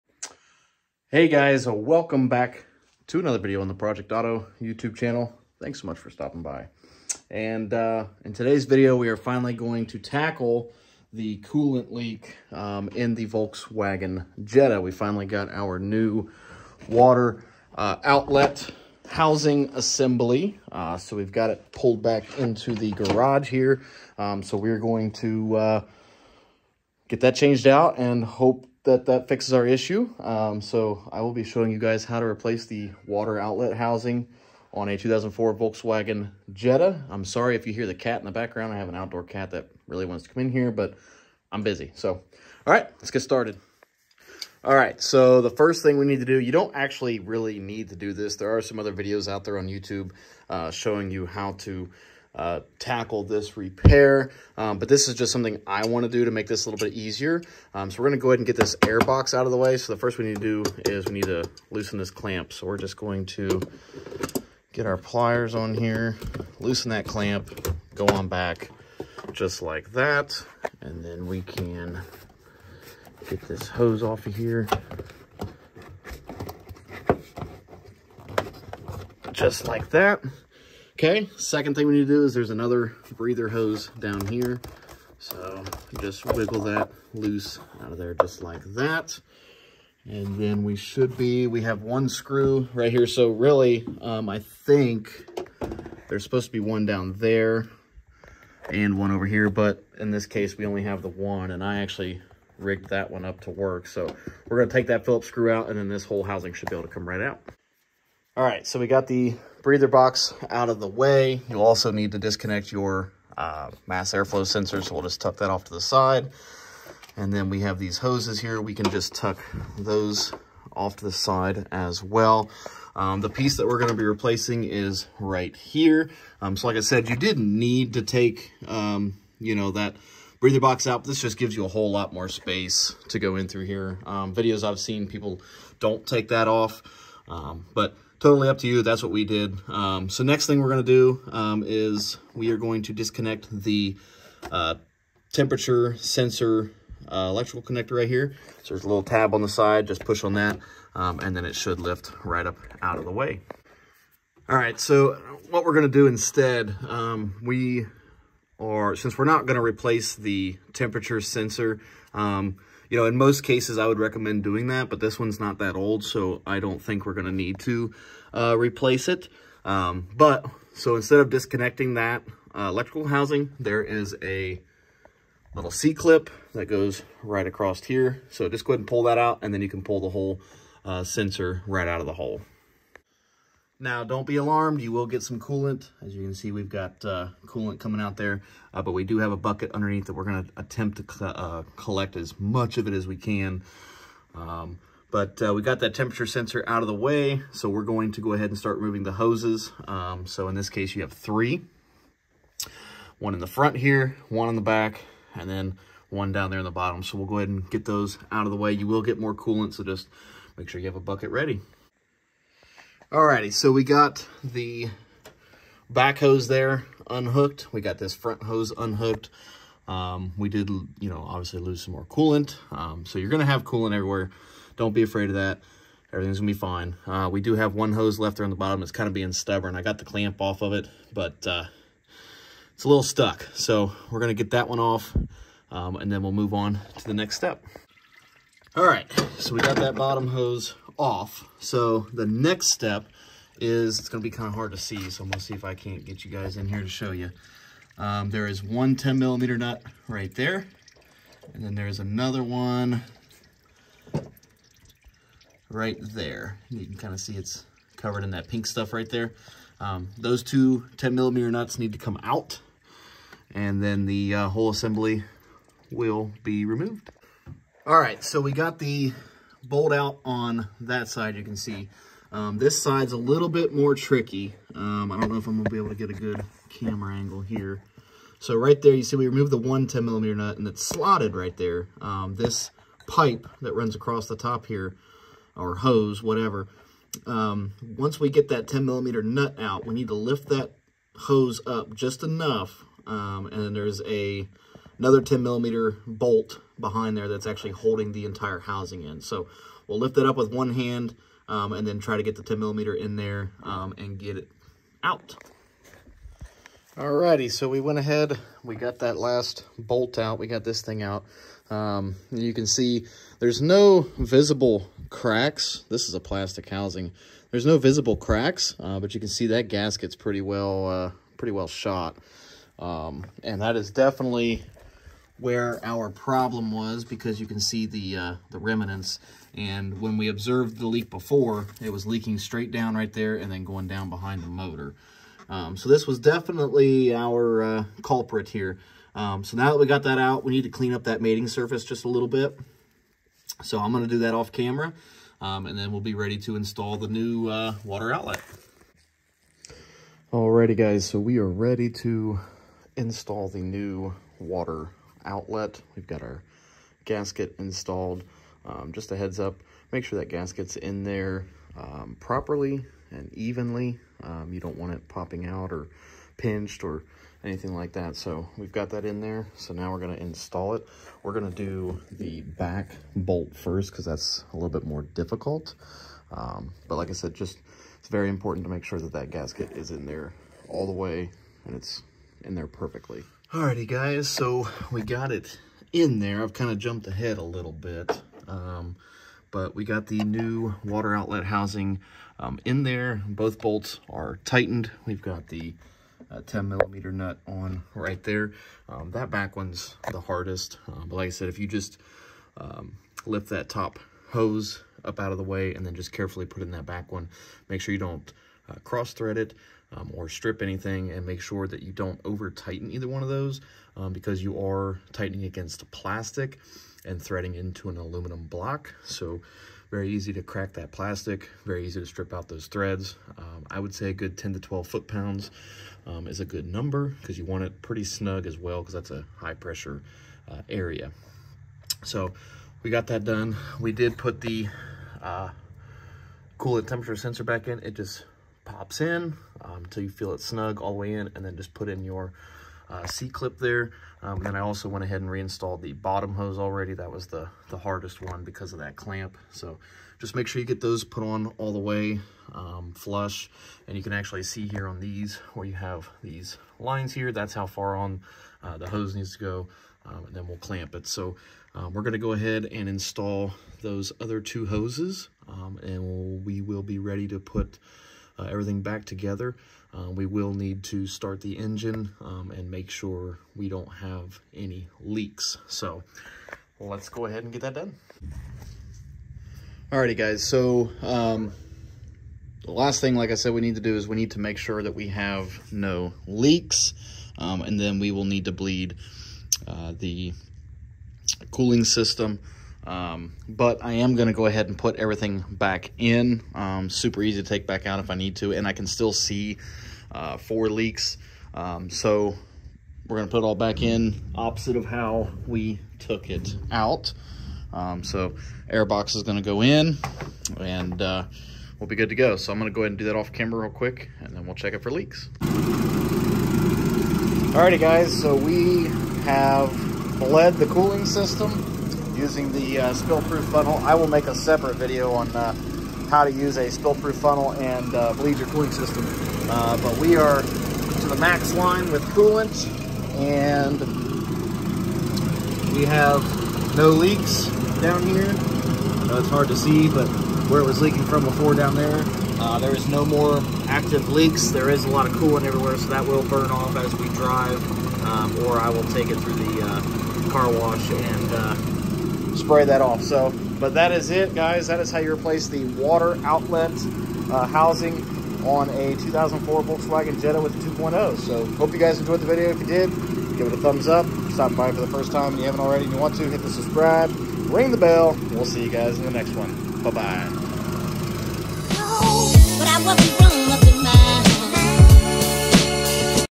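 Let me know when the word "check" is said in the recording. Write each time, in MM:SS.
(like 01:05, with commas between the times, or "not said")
08:34.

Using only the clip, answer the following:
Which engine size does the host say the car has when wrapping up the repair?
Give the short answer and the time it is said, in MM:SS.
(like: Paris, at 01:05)
2.0, at 09:20.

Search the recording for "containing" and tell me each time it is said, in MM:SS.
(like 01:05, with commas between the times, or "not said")
not said.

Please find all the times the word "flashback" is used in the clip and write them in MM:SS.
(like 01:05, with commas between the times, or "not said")
not said.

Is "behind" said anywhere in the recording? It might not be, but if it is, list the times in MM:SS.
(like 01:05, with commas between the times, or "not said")
04:56, 05:34.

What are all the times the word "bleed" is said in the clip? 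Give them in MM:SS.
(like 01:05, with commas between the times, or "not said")
08:08, 08:48.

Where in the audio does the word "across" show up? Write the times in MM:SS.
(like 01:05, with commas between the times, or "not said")
02:57, 04:43.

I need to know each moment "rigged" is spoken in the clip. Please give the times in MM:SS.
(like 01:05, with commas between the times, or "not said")
01:42.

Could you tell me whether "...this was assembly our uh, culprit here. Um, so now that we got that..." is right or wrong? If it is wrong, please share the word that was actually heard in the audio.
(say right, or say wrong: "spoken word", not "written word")
wrong: "definitely", not "assembly".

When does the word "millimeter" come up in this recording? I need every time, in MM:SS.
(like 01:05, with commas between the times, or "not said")
04:09, 04:21, 04:40, 04:48, 04:55, 05:02, 06:36.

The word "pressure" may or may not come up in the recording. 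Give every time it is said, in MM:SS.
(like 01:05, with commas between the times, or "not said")
07:09.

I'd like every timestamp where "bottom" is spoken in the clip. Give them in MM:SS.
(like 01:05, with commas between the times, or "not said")
03:26, 03:48, 03:59, 07:25.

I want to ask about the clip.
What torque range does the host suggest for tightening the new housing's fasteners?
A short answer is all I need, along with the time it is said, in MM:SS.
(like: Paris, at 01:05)
10 to 12 foot-pounds, at 07:04.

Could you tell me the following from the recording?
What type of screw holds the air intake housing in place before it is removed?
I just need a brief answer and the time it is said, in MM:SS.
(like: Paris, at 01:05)
Phillips, at 01:45.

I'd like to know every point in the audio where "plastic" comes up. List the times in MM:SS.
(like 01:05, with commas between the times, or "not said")
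05:16, 06:55, 07:00.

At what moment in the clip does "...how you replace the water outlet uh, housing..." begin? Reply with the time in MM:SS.
09:14.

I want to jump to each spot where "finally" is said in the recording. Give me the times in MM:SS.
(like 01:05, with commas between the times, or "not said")
00:09, 00:14.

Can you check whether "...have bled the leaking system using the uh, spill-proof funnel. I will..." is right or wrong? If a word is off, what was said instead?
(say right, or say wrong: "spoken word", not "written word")
wrong: "cooling", not "leaking".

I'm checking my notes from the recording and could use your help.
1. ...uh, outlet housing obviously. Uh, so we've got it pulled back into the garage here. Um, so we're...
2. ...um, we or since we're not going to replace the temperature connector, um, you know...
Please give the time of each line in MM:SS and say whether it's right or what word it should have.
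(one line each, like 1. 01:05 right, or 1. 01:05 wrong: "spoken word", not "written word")
1. 00:17 wrong: "assembly", not "obviously"
2. 02:36 wrong: "sensor", not "connector".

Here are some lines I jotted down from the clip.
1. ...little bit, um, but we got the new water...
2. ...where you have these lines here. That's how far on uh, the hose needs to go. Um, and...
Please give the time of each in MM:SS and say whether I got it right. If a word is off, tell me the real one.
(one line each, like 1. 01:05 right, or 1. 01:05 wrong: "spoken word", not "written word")
1. 06:27 right
2. 07:35 right.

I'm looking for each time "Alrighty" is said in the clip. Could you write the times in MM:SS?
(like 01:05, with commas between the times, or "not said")
03:33, 05:06, 05:50, 06:23, 07:59, 08:37.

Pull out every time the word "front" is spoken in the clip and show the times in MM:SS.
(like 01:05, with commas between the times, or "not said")
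03:23, 03:38.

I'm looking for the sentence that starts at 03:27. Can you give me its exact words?
So we'll go ahead and get those out of the way.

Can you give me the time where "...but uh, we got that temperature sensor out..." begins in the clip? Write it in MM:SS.
03:15.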